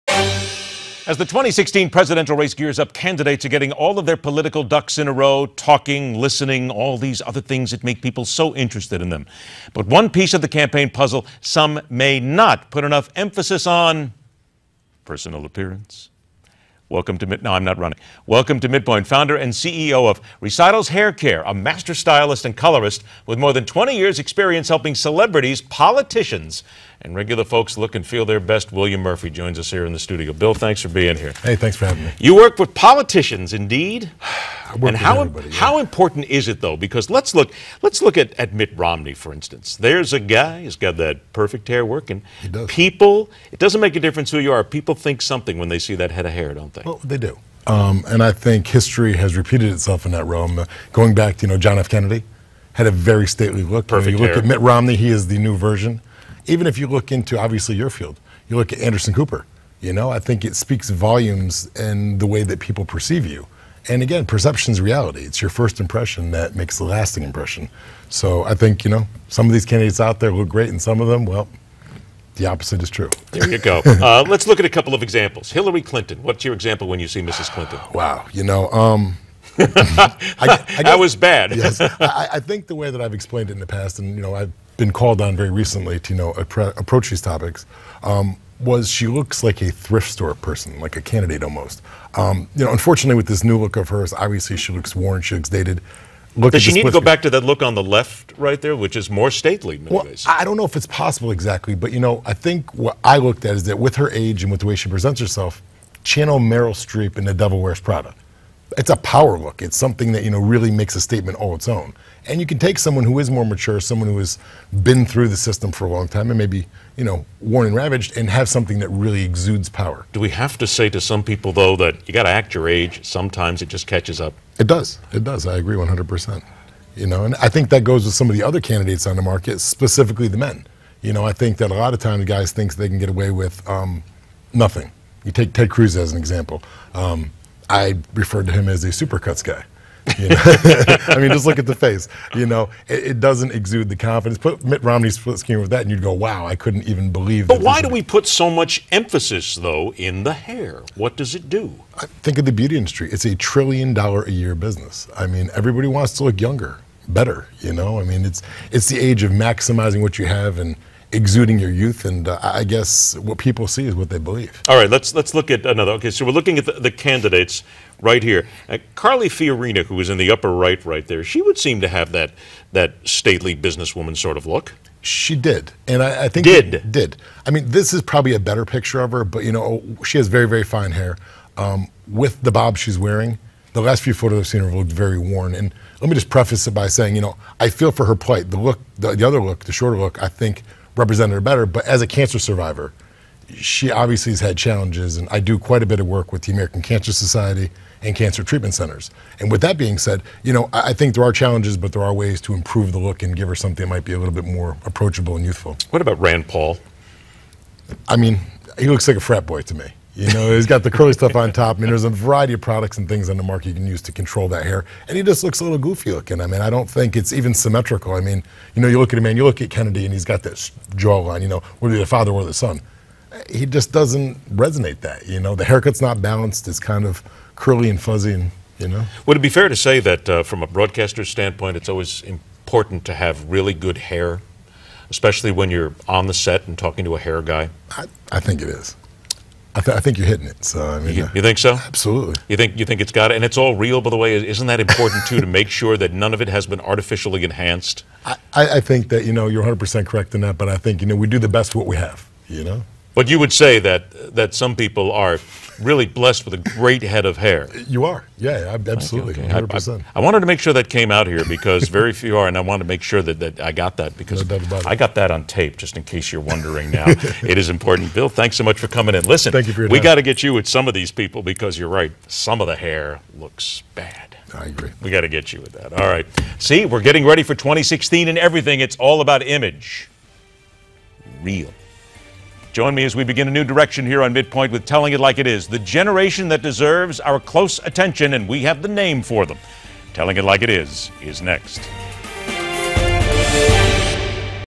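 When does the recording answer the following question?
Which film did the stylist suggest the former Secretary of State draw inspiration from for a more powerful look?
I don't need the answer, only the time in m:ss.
1:47.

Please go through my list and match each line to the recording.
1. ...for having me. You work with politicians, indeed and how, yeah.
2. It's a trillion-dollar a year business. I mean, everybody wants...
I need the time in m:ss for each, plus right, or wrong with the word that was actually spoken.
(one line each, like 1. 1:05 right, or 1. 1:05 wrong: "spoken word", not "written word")
1. 0:31 right
2. 2:33 right.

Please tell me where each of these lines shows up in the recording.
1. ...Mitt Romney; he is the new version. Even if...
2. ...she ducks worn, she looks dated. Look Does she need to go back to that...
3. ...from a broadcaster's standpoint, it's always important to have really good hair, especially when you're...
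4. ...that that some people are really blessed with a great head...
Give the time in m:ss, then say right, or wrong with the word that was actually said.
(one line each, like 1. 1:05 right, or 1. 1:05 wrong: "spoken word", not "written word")
1. 0:54 right
2. 1:34 wrong: "looks", not "ducks"
3. 3:50 right
4. 4:13 right.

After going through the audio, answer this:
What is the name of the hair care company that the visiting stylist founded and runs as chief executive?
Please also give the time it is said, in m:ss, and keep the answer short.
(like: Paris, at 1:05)
Recitals Hair Care, at 0:20.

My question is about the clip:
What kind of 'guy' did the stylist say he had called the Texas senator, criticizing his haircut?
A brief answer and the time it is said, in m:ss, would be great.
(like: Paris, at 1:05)
Supercuts guy, at 2:18.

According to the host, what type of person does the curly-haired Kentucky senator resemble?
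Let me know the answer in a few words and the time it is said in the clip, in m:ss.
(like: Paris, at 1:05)
Frat boy, at 3:29.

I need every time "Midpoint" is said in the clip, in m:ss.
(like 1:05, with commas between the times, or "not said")
0:18, 4:44.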